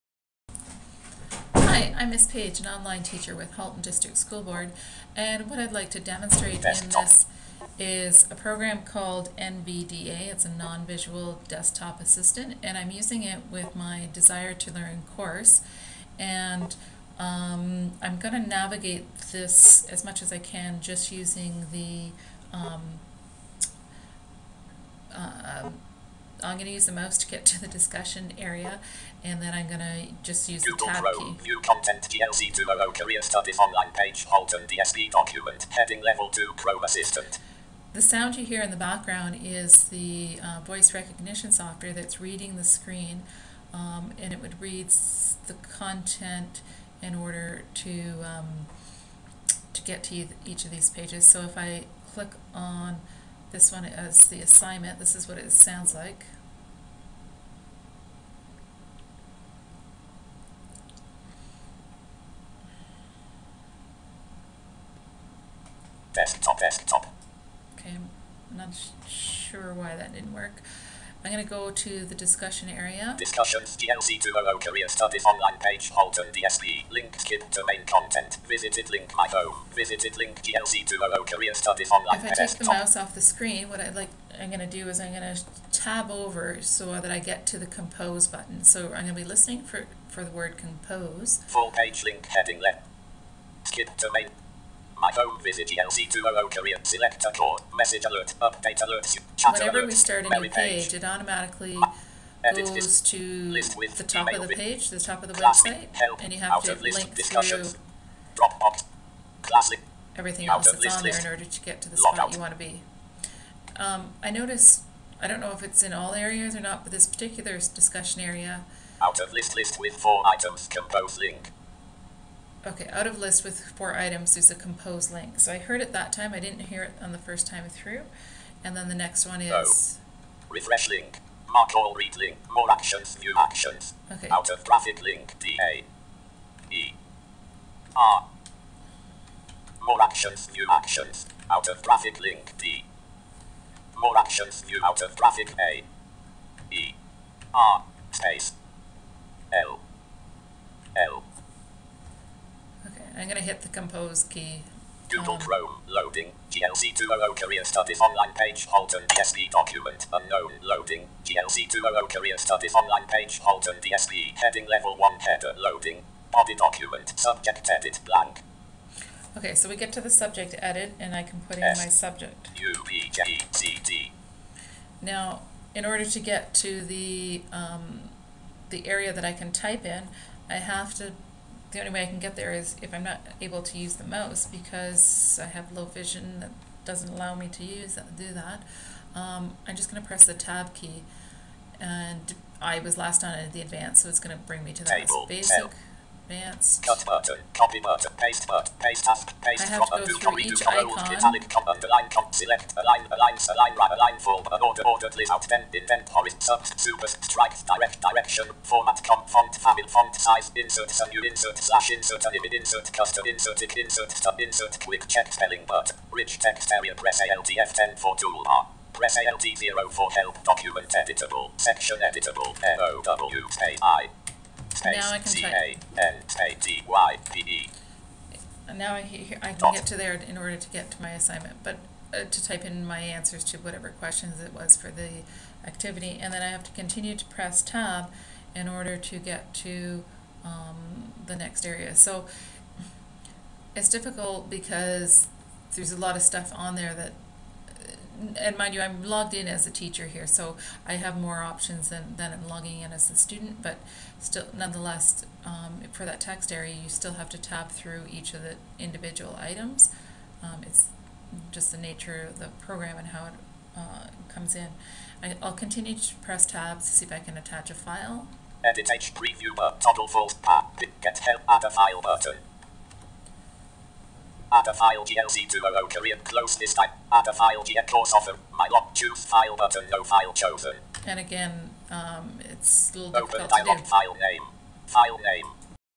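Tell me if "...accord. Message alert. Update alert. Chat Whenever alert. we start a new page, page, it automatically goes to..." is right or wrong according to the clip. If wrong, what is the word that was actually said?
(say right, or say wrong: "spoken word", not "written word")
right.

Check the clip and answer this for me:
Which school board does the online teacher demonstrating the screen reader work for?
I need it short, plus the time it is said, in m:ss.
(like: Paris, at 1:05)
Halton District School Board, at 0:03.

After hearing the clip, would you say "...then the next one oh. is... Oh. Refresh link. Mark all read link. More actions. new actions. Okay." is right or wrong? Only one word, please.
right.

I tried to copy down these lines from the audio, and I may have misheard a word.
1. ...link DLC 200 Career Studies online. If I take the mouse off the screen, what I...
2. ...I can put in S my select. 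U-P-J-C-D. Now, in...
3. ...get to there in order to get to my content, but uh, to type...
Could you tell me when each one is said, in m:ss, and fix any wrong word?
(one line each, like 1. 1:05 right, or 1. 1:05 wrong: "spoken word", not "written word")
1. 1:20 right
2. 2:51 wrong: "subject", not "select"
3. 3:49 wrong: "assignment", not "content".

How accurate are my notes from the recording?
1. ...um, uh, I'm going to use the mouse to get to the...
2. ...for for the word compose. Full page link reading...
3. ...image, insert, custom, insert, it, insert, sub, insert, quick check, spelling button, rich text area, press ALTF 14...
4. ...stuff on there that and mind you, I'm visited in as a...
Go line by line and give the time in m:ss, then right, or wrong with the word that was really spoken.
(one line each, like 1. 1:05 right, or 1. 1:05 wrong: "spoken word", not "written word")
1. 0:22 right
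2. 1:29 wrong: "heading", not "reading"
3. 3:32 wrong: "10", not "14"
4. 4:06 wrong: "logged", not "visited".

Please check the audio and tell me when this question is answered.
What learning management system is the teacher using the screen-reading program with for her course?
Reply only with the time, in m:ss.
0:14.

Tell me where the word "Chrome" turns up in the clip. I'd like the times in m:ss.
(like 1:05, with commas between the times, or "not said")
0:31, 0:36, 2:35.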